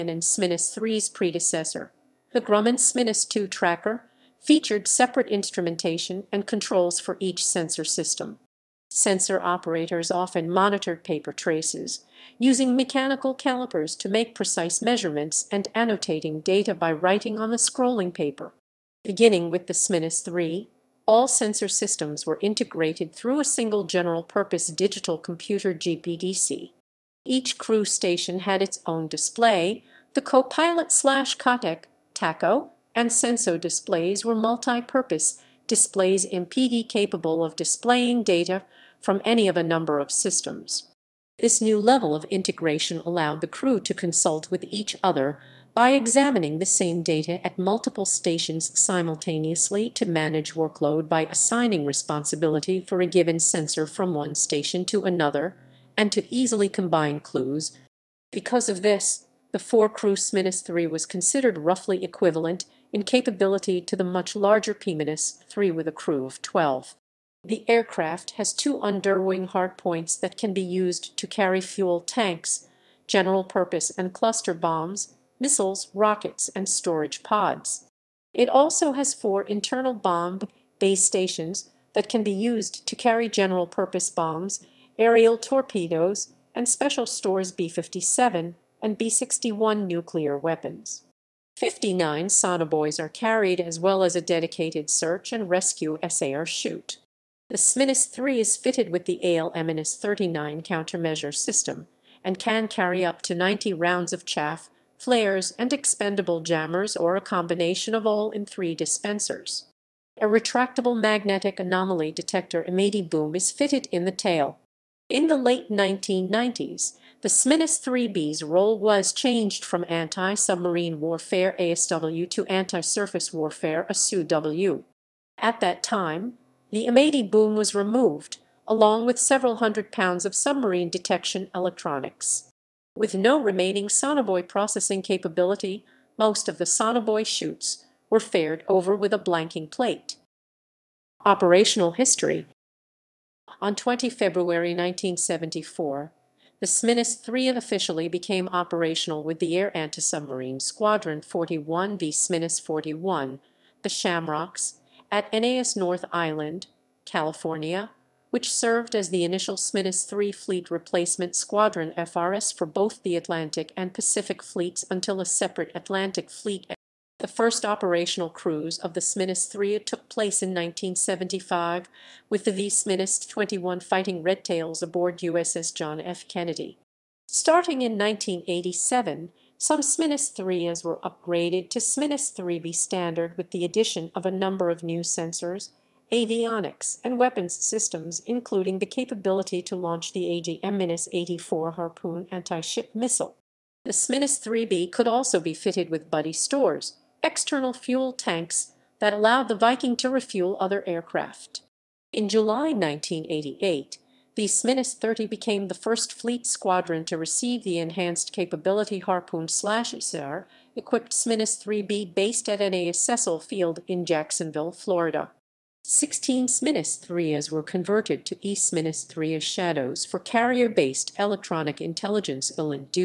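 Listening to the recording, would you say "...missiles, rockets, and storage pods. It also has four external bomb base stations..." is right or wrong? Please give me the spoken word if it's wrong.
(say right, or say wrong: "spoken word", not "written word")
wrong: "internal", not "external".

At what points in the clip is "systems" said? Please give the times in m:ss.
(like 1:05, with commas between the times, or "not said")
0:07, 0:21, 0:40, 1:41, 3:07.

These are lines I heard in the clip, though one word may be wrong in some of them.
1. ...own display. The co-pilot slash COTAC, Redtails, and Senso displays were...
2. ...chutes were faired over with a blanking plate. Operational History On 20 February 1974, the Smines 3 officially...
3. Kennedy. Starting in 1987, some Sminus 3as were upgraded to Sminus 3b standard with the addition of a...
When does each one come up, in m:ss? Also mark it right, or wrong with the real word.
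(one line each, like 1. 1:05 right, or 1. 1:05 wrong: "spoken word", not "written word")
1. 0:28 wrong: "TACO", not "Redtails"
2. 2:17 right
3. 2:56 right.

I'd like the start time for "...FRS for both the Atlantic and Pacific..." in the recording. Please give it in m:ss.
2:41.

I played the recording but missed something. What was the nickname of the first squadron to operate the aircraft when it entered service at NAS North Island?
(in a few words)
the Shamrocks.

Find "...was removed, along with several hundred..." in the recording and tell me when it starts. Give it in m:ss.
2:07.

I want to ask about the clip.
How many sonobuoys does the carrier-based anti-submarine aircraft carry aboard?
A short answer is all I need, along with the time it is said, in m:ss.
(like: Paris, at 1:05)
59, at 1:31.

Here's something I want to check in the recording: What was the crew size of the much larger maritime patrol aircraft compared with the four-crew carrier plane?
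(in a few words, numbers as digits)
12.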